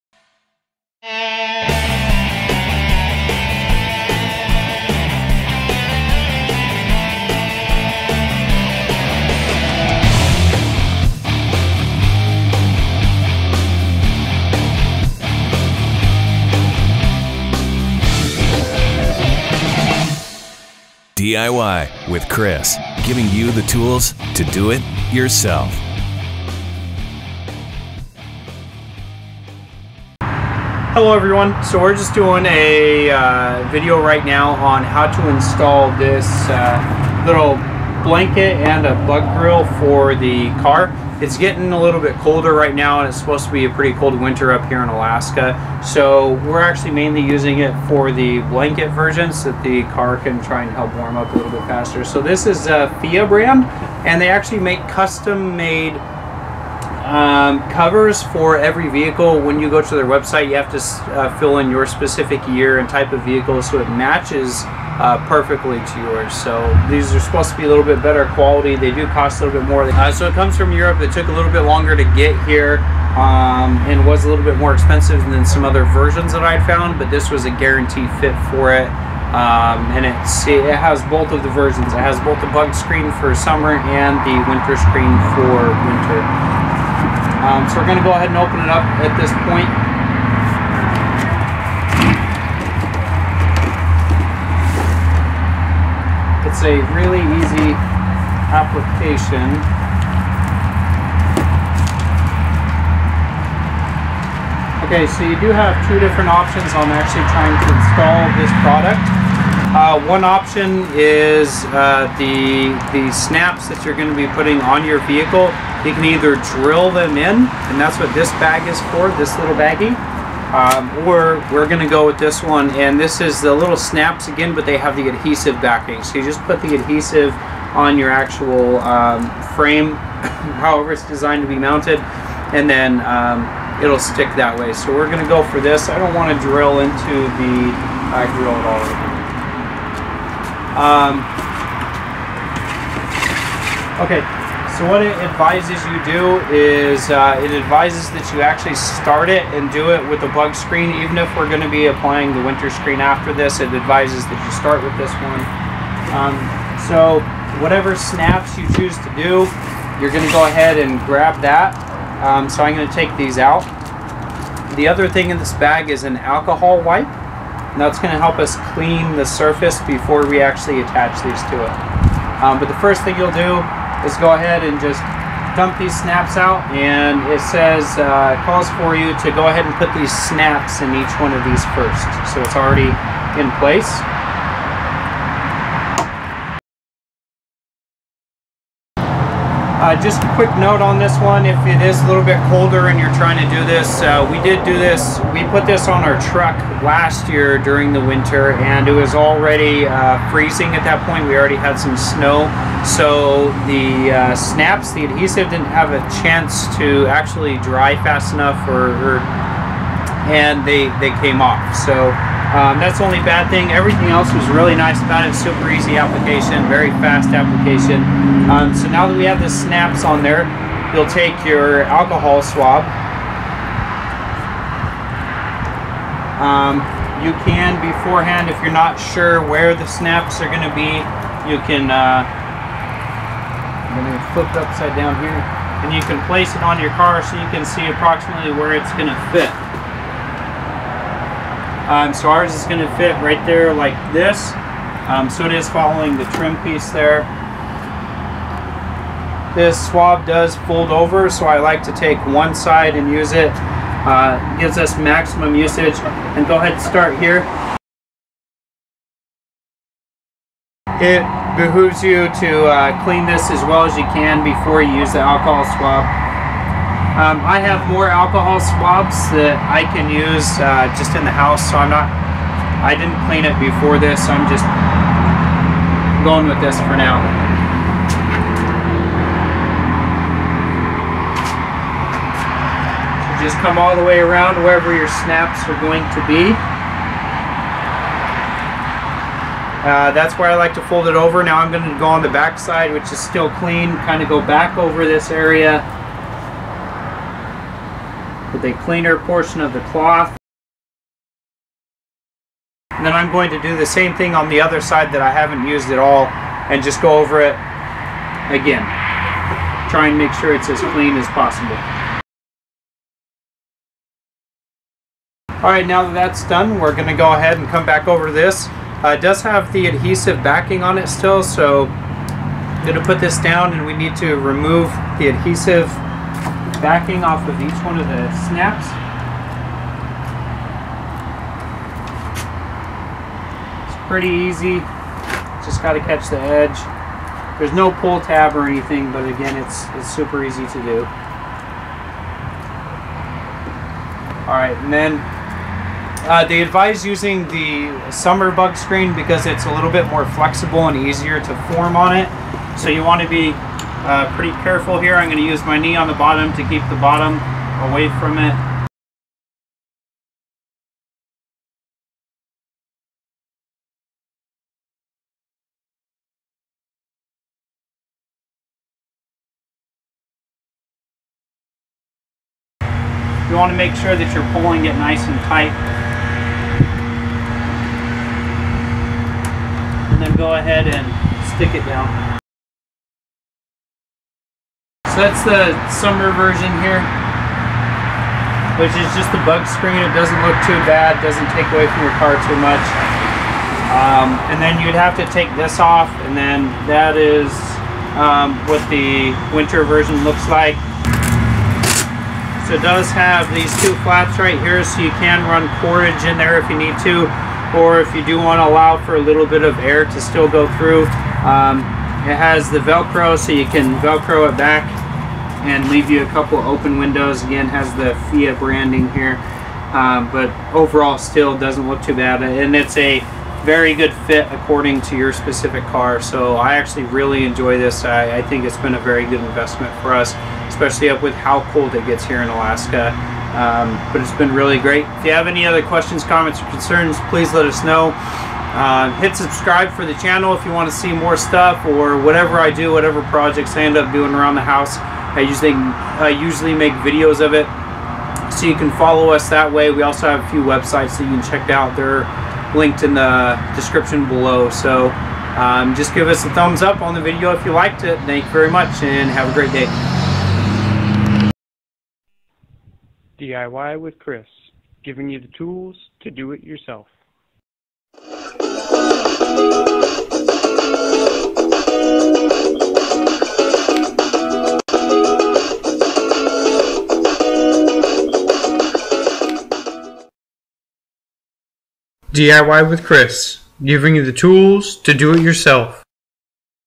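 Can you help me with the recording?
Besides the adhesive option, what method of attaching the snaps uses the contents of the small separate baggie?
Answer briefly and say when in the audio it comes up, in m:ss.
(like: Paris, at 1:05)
drill them in, at 1:56.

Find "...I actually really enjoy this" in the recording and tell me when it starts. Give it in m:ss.
7:06.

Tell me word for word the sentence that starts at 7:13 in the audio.
Um, but it's been really great.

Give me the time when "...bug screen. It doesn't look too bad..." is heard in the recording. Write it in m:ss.
6:29.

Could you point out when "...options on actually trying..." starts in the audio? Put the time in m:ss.
1:46.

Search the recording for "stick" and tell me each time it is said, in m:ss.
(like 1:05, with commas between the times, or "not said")
2:14, 6:21.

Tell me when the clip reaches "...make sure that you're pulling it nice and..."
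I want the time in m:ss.
6:13.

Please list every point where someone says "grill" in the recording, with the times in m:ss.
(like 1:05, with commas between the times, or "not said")
0:39, 2:18.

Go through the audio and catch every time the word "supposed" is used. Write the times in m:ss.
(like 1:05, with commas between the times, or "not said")
0:43, 1:07.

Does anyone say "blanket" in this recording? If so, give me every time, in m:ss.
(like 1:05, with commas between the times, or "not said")
0:38, 0:48.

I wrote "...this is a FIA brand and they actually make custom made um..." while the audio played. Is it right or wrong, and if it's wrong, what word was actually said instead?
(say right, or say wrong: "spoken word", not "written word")
right.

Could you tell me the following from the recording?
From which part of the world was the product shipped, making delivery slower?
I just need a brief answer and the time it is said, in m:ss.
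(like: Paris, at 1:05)
Europe, at 1:10.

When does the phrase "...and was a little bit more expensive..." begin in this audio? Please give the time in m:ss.
1:13.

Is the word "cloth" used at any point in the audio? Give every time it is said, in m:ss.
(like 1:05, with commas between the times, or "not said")
4:59.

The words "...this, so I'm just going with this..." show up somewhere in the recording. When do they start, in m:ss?
4:33.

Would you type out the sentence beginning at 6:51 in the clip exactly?
Um, it has the Velcro, so you can Velcro it back and leave you a couple open windows.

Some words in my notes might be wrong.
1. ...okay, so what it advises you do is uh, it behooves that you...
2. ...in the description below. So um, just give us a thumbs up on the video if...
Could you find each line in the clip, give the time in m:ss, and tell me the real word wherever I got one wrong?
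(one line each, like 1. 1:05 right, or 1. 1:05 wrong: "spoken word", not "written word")
1. 2:24 wrong: "advises", not "behooves"
2. 7:33 right.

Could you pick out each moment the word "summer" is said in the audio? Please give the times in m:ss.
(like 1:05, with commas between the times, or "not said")
1:23, 5:48, 6:25.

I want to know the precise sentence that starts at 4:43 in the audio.
So just come all the way around wherever your snaps are going to be.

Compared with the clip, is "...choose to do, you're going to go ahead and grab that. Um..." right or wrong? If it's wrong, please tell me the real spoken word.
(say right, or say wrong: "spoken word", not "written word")
right.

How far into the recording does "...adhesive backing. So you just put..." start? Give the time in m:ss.
2:05.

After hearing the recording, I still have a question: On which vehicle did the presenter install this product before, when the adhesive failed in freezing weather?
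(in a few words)
truck.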